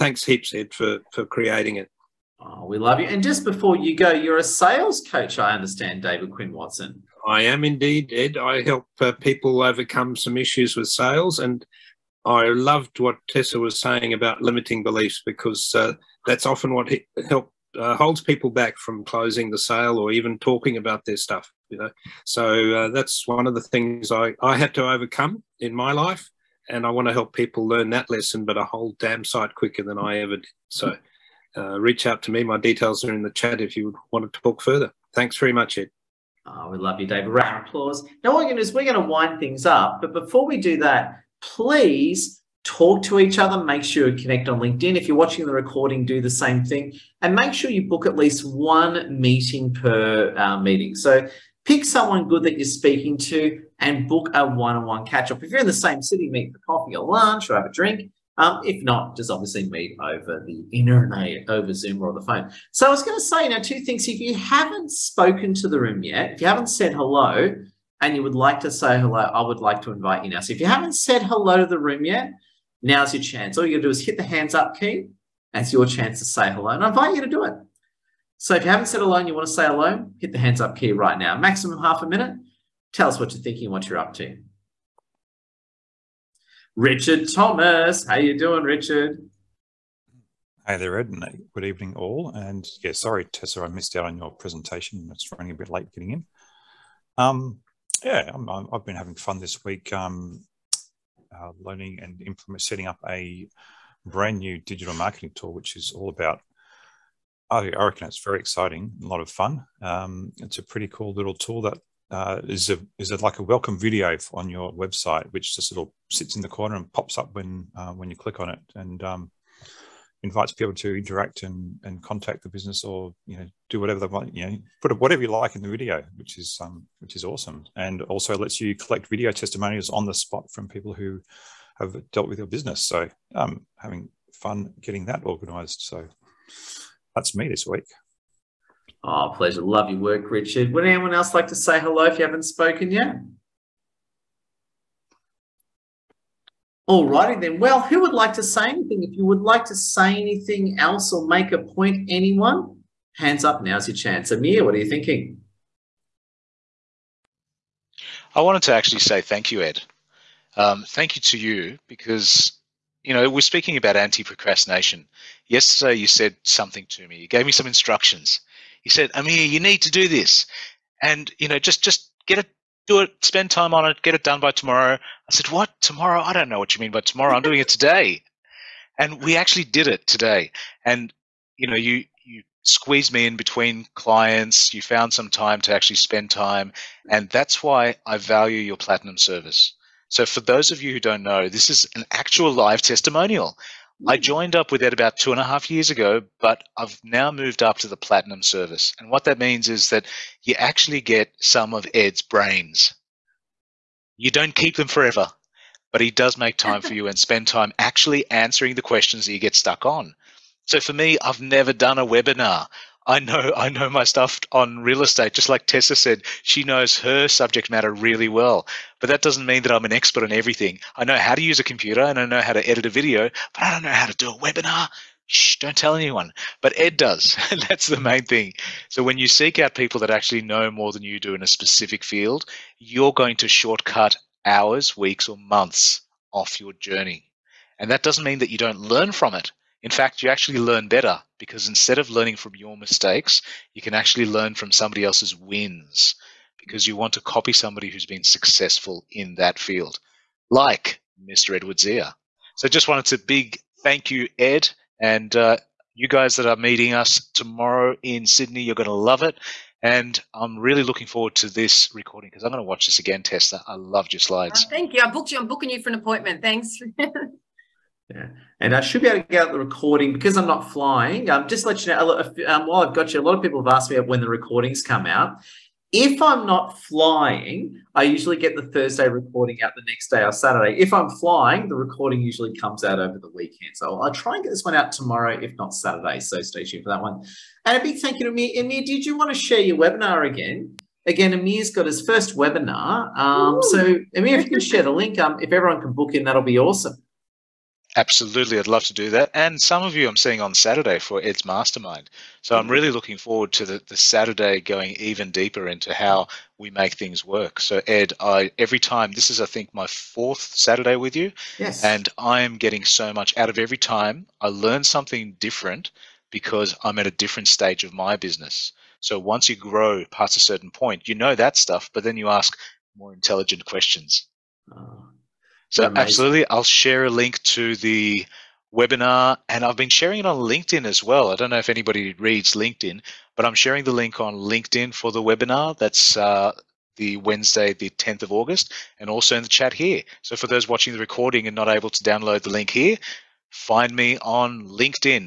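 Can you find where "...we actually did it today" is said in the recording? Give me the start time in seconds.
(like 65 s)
179 s.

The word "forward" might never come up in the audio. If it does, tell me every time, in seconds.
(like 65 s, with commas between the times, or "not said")
261 s, 303 s.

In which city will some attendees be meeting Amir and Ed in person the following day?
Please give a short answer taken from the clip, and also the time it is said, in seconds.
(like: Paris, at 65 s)
Sydney, at 258 s.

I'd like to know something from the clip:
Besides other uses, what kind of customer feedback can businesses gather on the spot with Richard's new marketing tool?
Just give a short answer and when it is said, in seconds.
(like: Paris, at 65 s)
video testimonials, at 129 s.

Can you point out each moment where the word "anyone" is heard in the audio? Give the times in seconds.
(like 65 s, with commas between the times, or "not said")
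140 s, 152 s, 225 s.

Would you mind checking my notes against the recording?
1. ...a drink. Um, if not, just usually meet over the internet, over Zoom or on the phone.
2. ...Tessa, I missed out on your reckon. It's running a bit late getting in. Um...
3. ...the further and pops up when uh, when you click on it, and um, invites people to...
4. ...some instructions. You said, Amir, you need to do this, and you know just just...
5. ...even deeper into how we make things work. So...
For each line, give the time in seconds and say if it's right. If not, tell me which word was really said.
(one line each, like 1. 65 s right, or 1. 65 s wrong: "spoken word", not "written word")
1. 57 s wrong: "obviously", not "usually"
2. 93 s wrong: "presentation", not "reckon"
3. 116 s wrong: "corner", not "further"
4. 167 s right
5. 304 s right.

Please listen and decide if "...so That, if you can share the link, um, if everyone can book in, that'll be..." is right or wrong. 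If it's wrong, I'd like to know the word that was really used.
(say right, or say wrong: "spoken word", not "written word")
wrong: "Amir", not "That".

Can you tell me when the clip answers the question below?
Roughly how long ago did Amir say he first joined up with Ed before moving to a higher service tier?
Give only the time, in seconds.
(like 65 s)
195 s.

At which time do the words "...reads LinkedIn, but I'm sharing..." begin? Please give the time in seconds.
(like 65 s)
332 s.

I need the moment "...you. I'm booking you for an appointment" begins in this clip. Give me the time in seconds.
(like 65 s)
265 s.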